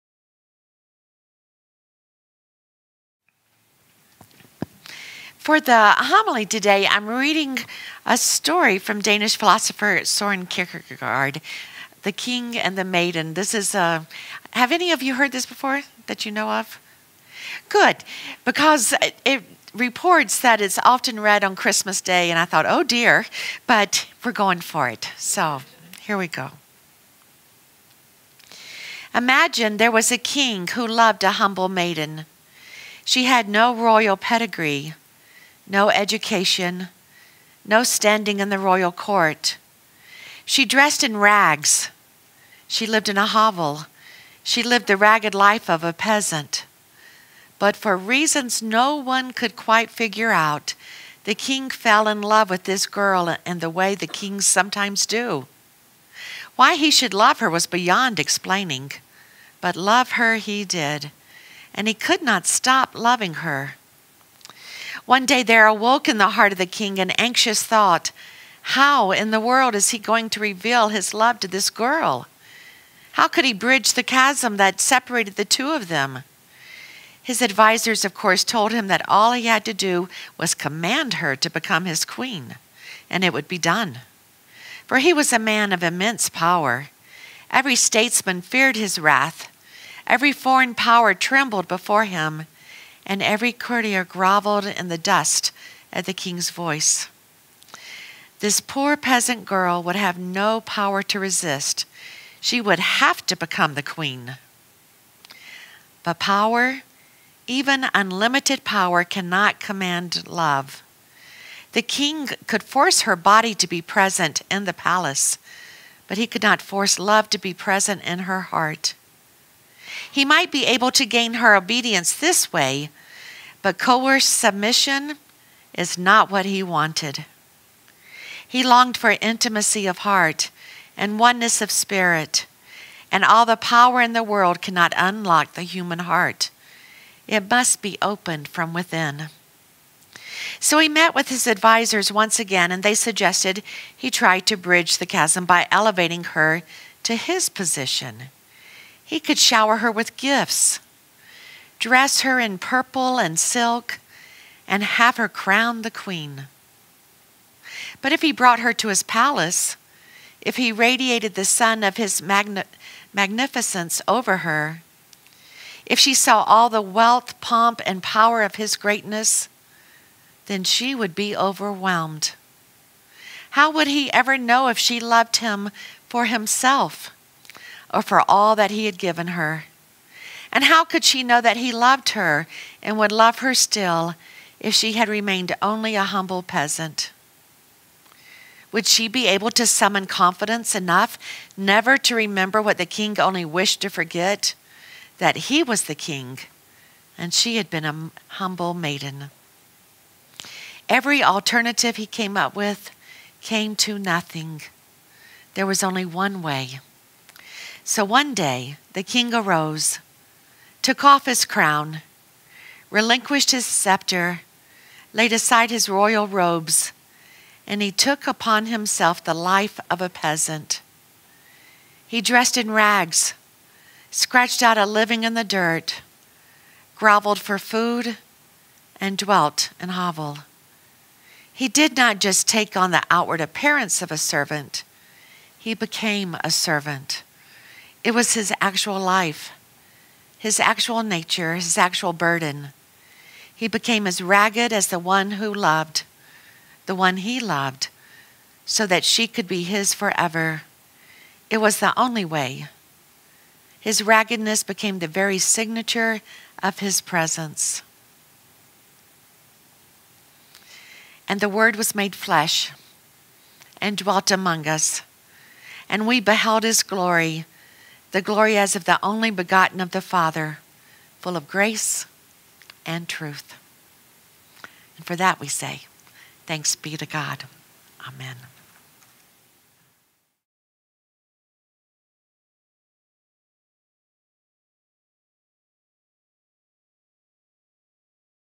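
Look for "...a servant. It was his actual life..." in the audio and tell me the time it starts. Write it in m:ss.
3:56.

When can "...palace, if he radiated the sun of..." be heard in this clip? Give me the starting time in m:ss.
2:39.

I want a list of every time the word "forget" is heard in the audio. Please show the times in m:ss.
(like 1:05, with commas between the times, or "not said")
3:13.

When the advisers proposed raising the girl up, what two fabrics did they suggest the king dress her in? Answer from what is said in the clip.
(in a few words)
purple and silk.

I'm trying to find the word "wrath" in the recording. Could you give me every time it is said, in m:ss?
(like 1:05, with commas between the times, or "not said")
1:28.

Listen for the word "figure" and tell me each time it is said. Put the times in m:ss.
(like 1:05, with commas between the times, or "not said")
0:49.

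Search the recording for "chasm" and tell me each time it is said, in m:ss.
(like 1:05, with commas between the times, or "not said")
1:14, 2:25.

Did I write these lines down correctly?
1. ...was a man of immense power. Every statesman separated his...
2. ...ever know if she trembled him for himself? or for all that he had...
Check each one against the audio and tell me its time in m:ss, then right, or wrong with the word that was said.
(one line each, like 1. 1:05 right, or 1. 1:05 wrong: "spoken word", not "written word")
1. 1:25 wrong: "feared", not "separated"
2. 2:54 wrong: "loved", not "trembled".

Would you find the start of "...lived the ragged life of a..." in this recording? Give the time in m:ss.
0:44.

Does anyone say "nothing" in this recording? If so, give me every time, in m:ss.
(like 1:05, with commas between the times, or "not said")
3:23.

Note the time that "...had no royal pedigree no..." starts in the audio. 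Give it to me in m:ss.
0:33.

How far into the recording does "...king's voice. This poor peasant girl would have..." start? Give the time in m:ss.
1:36.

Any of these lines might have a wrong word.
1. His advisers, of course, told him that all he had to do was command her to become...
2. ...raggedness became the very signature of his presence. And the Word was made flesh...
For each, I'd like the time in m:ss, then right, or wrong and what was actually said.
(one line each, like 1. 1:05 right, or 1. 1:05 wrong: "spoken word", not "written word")
1. 1:17 right
2. 4:14 right.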